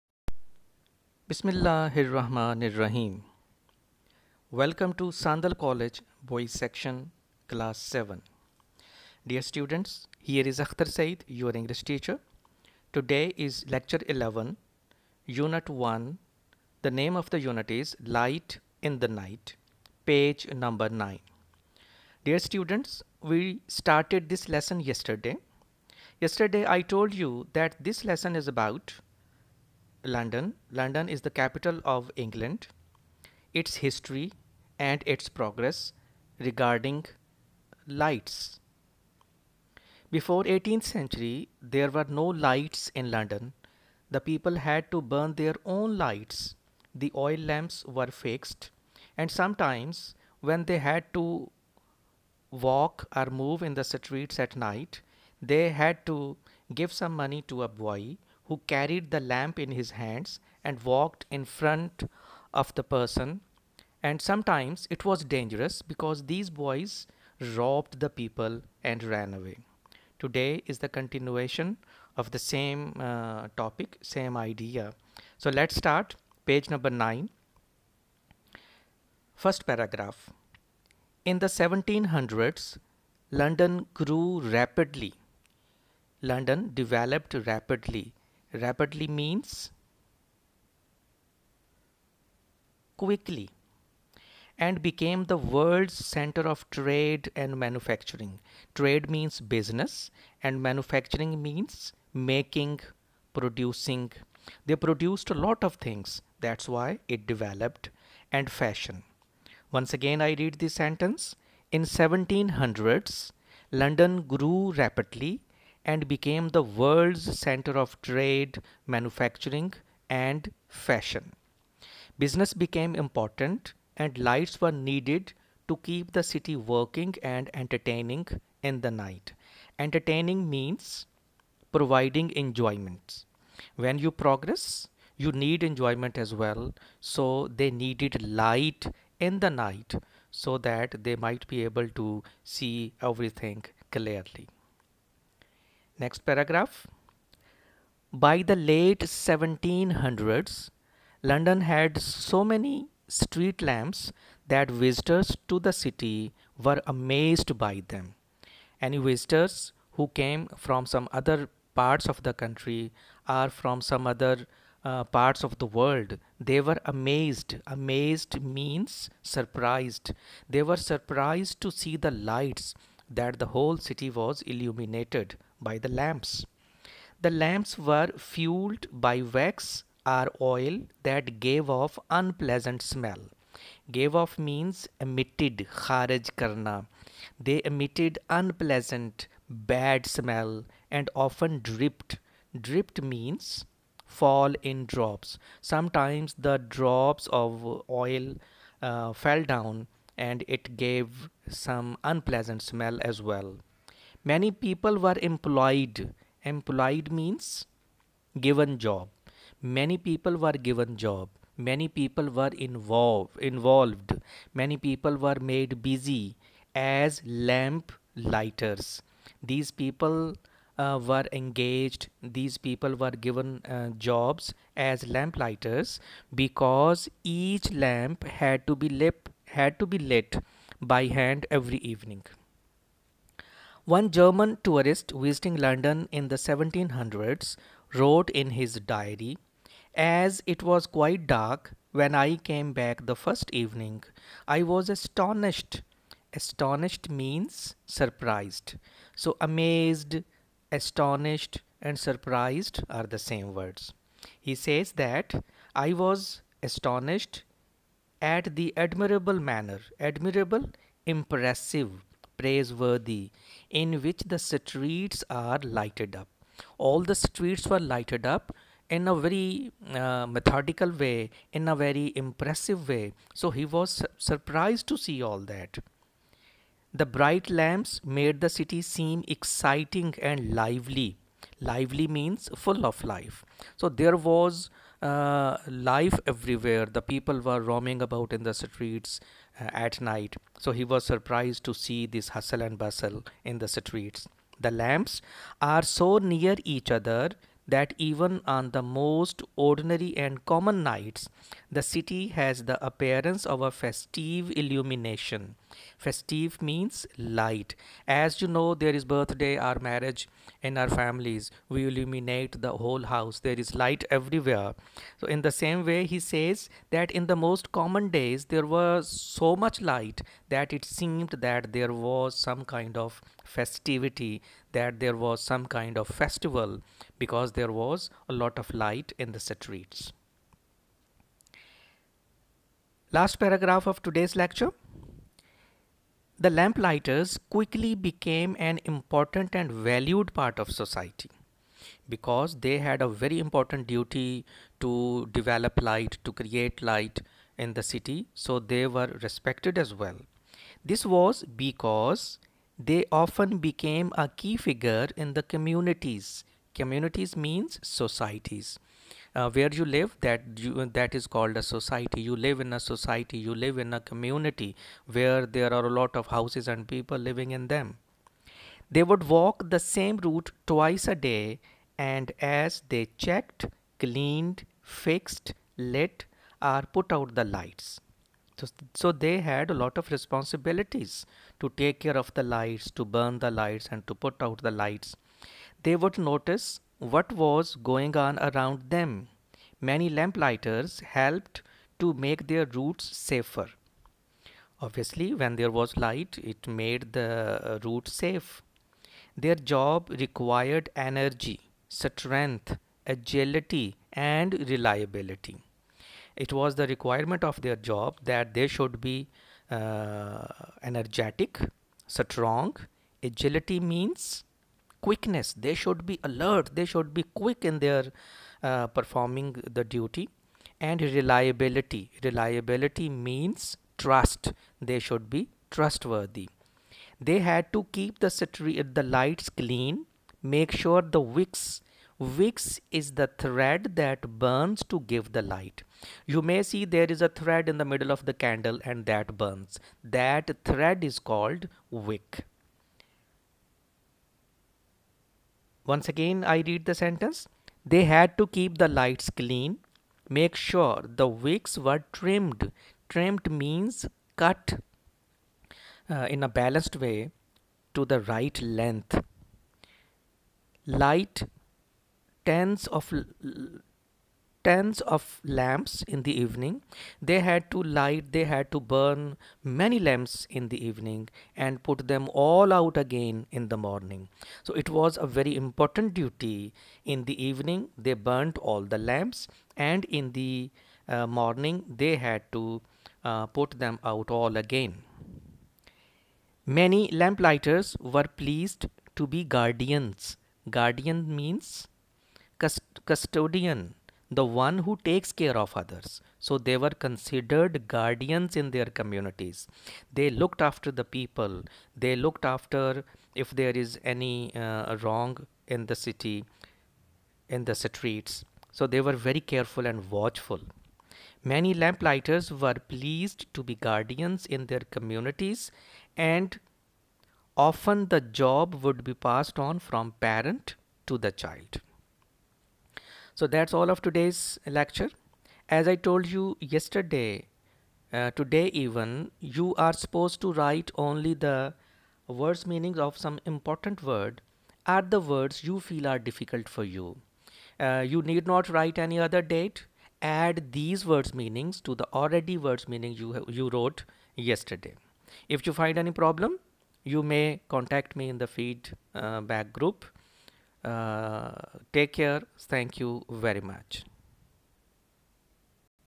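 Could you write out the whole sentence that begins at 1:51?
In 1700s, London grew rapidly and became the world's center of trade, manufacturing, and fashion.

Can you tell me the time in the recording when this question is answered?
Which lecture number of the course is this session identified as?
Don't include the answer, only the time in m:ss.
0:13.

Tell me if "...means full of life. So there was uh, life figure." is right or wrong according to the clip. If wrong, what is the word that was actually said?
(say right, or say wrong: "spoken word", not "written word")
wrong: "everywhere", not "figure".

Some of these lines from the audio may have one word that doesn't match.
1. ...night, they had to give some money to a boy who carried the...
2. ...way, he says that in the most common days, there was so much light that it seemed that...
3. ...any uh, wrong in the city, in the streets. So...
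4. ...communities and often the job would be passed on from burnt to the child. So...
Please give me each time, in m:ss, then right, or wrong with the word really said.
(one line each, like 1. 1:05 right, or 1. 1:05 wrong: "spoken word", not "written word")
1. 0:54 right
2. 5:15 right
3. 8:24 right
4. 8:34 wrong: "parent", not "burnt".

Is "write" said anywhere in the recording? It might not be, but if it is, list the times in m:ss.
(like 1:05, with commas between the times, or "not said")
8:50, 8:58.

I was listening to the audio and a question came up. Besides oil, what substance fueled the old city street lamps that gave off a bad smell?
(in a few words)
wax.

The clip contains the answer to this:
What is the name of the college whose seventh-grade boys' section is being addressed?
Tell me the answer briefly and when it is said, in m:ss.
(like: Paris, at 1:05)
Sandal College, at 0:05.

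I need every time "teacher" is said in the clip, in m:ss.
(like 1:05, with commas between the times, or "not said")
0:11.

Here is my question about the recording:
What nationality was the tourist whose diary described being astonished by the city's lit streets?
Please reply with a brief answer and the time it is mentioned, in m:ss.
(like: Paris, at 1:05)
German, at 3:54.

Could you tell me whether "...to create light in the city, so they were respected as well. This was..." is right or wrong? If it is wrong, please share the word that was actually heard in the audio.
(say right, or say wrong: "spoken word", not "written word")
right.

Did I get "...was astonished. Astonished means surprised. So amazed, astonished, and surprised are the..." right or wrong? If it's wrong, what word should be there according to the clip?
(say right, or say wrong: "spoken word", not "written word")
right.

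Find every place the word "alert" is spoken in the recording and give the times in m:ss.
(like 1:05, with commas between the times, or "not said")
6:56.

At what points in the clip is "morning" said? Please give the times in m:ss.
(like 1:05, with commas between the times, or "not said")
7:53, 8:01.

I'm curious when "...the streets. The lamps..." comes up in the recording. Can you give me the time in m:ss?
4:53.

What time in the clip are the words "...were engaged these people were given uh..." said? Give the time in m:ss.
3:41.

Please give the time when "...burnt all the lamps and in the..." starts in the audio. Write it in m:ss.
7:58.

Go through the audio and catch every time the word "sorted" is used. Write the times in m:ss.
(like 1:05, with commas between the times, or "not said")
not said.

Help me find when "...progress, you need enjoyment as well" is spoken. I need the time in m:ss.
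2:14.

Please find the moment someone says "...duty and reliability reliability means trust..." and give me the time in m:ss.
6:59.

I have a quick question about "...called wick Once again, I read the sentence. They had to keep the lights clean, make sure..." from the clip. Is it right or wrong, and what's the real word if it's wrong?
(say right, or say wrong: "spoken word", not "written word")
right.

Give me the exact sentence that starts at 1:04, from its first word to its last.
And sometimes it was dangerous because these boys robbed the people and ran away.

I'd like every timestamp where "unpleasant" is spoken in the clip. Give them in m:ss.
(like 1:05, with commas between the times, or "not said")
3:02, 3:08, 3:22.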